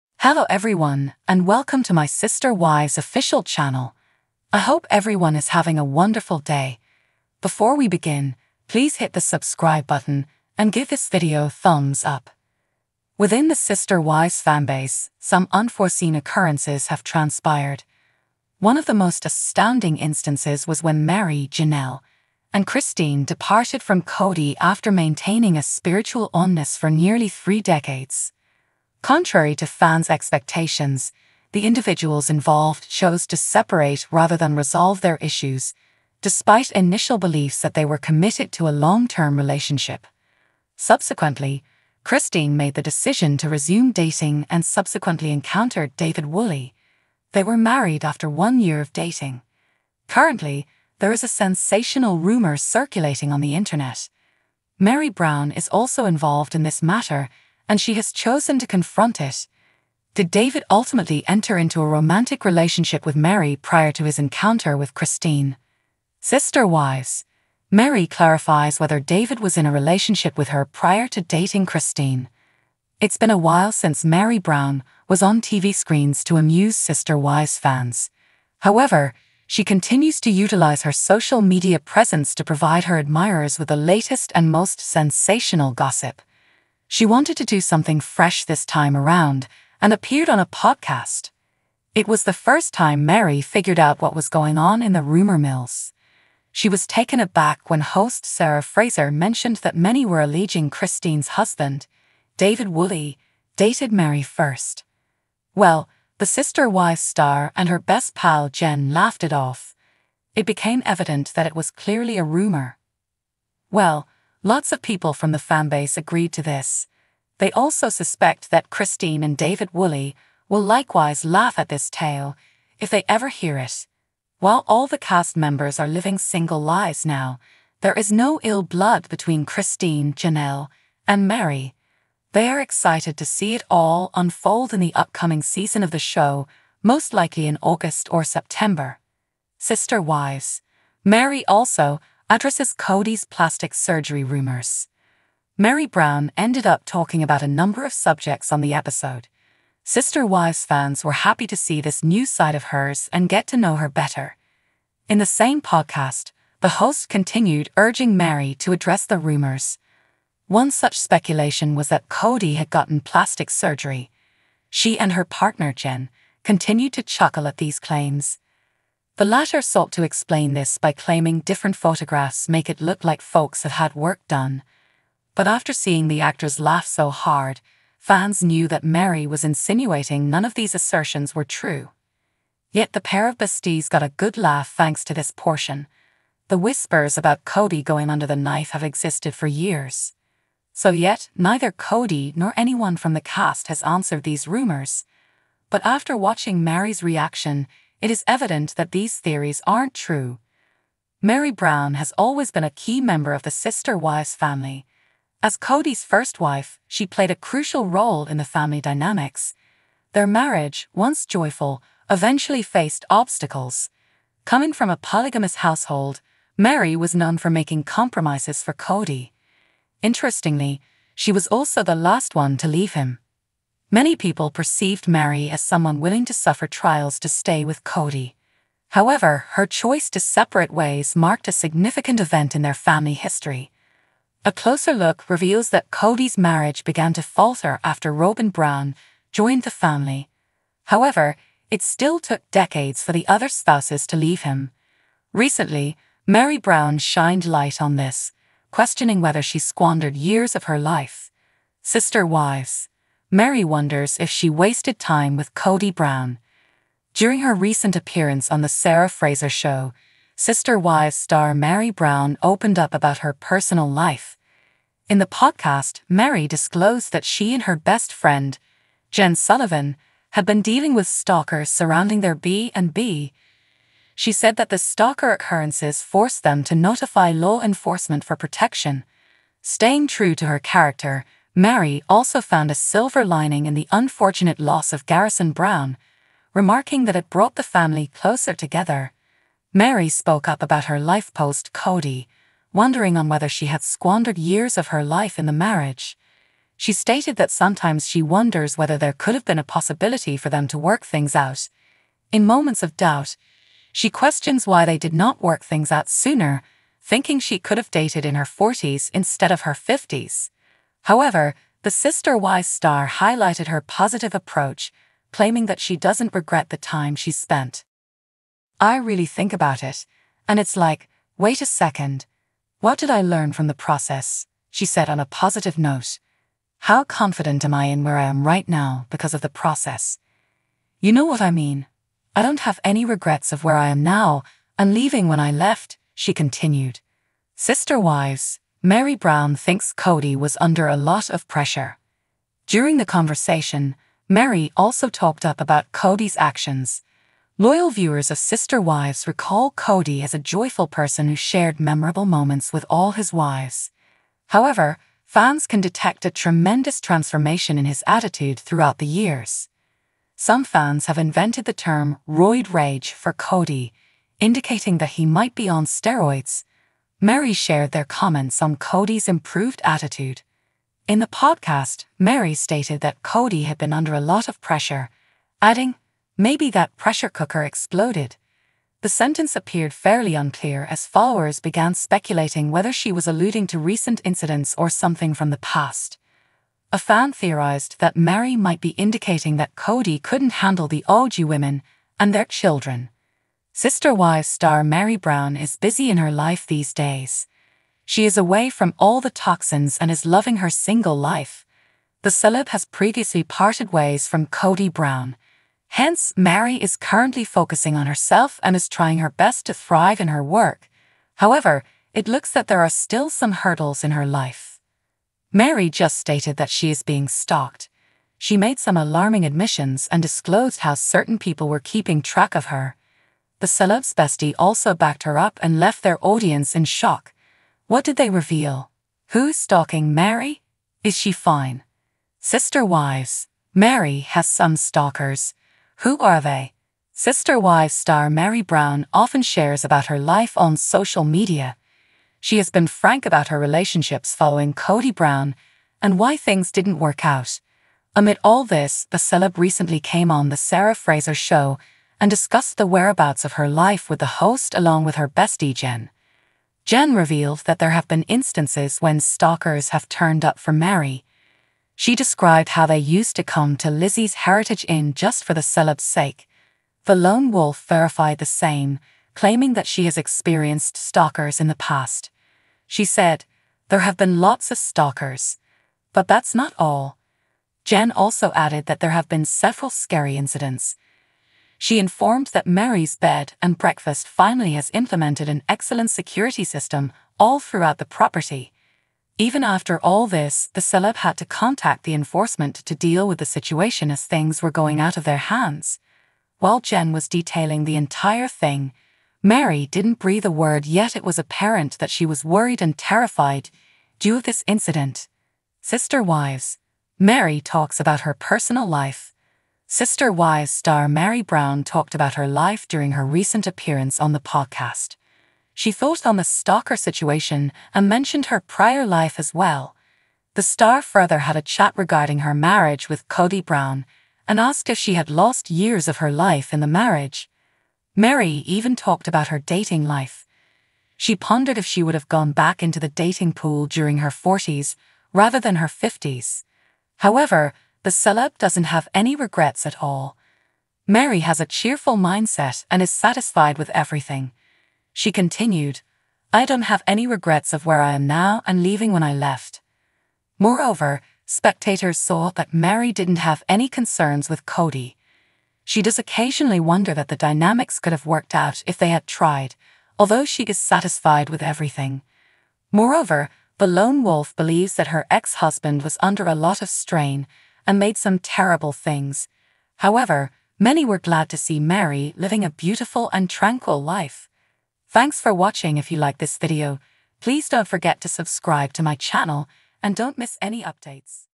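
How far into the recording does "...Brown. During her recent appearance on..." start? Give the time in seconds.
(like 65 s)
255 s.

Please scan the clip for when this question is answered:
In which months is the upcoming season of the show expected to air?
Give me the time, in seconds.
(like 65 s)
137 s.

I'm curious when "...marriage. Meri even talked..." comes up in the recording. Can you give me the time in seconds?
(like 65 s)
526 s.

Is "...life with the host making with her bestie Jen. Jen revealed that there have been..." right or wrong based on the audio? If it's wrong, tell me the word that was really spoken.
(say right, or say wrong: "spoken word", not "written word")
wrong: "along", not "making".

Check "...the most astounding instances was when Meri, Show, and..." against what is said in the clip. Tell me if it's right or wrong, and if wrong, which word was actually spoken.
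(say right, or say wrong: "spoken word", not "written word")
wrong: "Janelle", not "Show".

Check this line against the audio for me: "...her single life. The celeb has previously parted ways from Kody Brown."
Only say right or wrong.
right.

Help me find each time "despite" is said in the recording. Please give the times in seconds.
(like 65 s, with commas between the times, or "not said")
36 s.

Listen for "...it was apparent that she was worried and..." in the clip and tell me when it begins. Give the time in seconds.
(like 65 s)
501 s.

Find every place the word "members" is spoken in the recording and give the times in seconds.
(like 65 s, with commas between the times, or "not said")
125 s, 202 s.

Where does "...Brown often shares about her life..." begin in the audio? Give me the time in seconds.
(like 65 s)
438 s.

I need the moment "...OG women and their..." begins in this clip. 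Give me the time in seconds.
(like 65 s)
391 s.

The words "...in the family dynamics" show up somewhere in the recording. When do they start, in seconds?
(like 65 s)
208 s.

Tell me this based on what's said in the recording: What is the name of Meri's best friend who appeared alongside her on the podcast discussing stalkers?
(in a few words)
Jen Sullivan.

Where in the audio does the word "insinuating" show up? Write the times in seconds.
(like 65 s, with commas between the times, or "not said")
179 s.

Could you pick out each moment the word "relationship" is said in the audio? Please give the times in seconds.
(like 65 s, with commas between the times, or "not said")
39 s, 62 s, 69 s, 443 s.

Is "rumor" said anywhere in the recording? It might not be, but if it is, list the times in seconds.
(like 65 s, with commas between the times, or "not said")
52 s, 95 s, 112 s, 144 s, 159 s, 194 s.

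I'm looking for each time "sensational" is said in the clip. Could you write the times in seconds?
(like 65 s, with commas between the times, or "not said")
51 s, 84 s.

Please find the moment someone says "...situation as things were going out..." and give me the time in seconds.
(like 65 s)
493 s.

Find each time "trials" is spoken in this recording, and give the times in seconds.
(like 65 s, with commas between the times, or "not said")
226 s.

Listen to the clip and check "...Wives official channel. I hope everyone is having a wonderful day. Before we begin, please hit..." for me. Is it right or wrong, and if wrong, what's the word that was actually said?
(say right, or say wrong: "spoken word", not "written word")
right.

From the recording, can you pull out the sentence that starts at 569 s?
However, many were glad to see Meri living a beautiful and tranquil life.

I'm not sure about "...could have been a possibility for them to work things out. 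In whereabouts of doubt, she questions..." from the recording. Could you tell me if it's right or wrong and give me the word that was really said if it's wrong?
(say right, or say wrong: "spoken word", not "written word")
wrong: "moments", not "whereabouts".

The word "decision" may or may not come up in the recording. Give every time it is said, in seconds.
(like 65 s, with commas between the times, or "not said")
42 s.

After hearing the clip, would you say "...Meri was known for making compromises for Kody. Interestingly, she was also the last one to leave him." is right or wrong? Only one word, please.
right.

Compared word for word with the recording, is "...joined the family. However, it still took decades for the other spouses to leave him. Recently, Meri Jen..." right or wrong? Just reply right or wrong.
wrong.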